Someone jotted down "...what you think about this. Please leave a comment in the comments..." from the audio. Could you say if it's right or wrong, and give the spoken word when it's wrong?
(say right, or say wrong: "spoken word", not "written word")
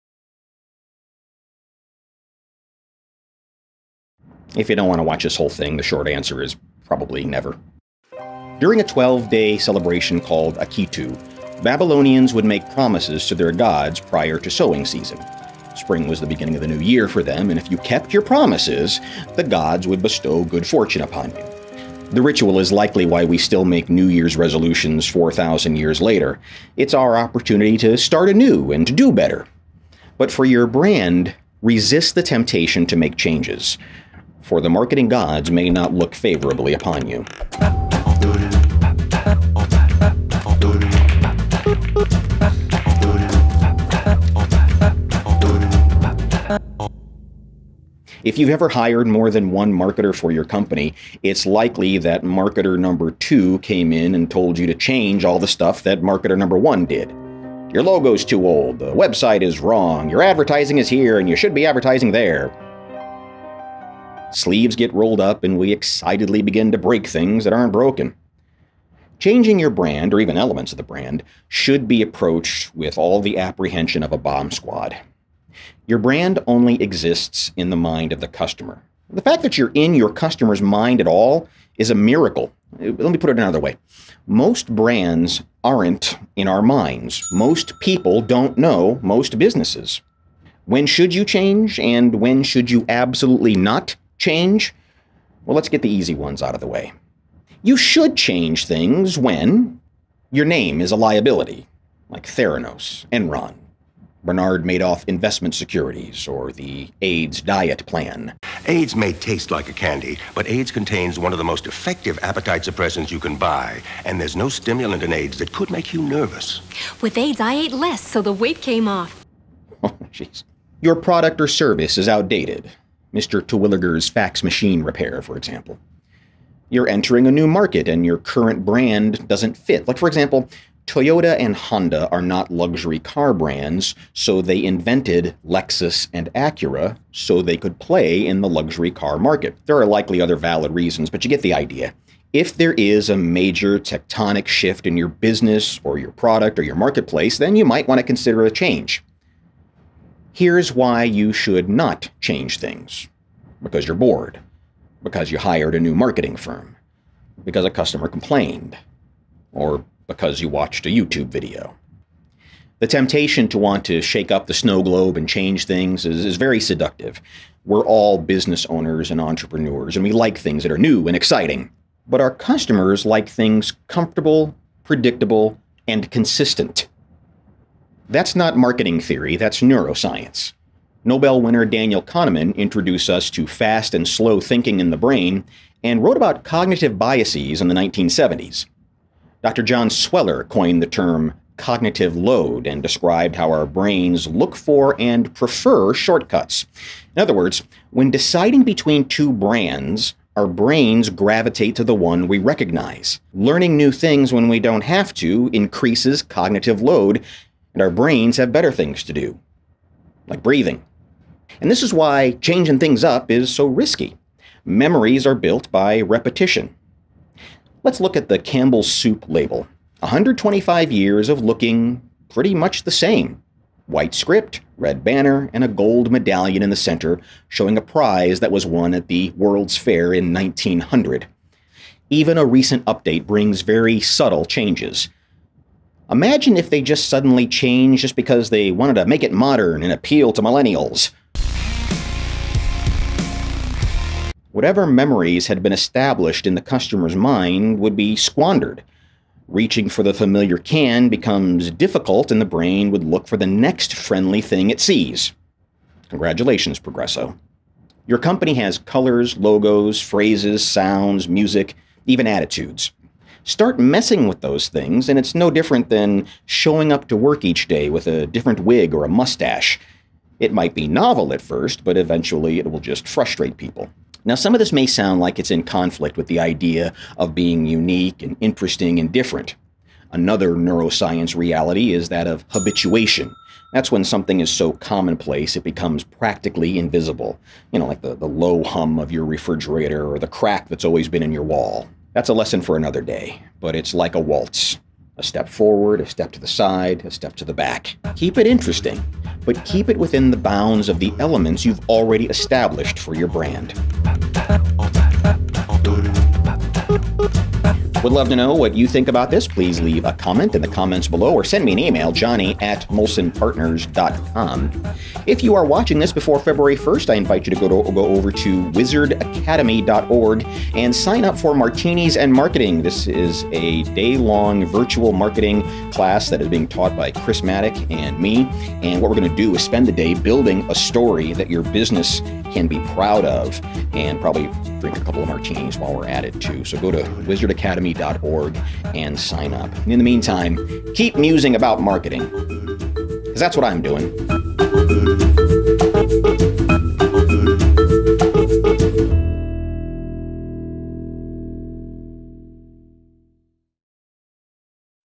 right.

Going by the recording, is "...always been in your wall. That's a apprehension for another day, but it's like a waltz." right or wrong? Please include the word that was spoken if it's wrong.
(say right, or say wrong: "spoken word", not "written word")
wrong: "lesson", not "apprehension".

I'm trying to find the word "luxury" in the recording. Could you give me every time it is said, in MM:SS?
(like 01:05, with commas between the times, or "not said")
02:12, 02:18.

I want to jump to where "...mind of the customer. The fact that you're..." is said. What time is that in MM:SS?
01:17.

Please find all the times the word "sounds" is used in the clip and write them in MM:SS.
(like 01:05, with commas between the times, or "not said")
04:20, 04:34.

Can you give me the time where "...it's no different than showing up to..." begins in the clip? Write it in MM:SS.
04:25.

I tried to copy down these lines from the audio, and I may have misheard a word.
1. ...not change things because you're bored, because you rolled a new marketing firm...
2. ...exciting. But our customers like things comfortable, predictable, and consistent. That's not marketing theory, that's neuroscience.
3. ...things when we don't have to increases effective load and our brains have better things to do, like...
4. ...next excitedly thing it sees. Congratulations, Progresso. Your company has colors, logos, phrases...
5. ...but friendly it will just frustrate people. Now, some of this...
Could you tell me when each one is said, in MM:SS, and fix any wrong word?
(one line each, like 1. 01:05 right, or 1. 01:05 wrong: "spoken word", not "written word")
1. 02:31 wrong: "hired", not "rolled"
2. 02:51 right
3. 03:23 wrong: "cognitive", not "effective"
4. 04:13 wrong: "friendly", not "excitedly"
5. 04:31 wrong: "eventually", not "friendly".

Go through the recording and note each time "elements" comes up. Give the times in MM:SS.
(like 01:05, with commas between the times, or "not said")
01:10, 05:01.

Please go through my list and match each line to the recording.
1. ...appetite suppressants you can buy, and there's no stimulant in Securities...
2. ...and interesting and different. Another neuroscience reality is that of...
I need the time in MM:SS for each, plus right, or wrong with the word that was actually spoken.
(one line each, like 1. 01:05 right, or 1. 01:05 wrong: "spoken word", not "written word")
1. 01:52 wrong: "Ayds", not "Securities"
2. 04:38 right.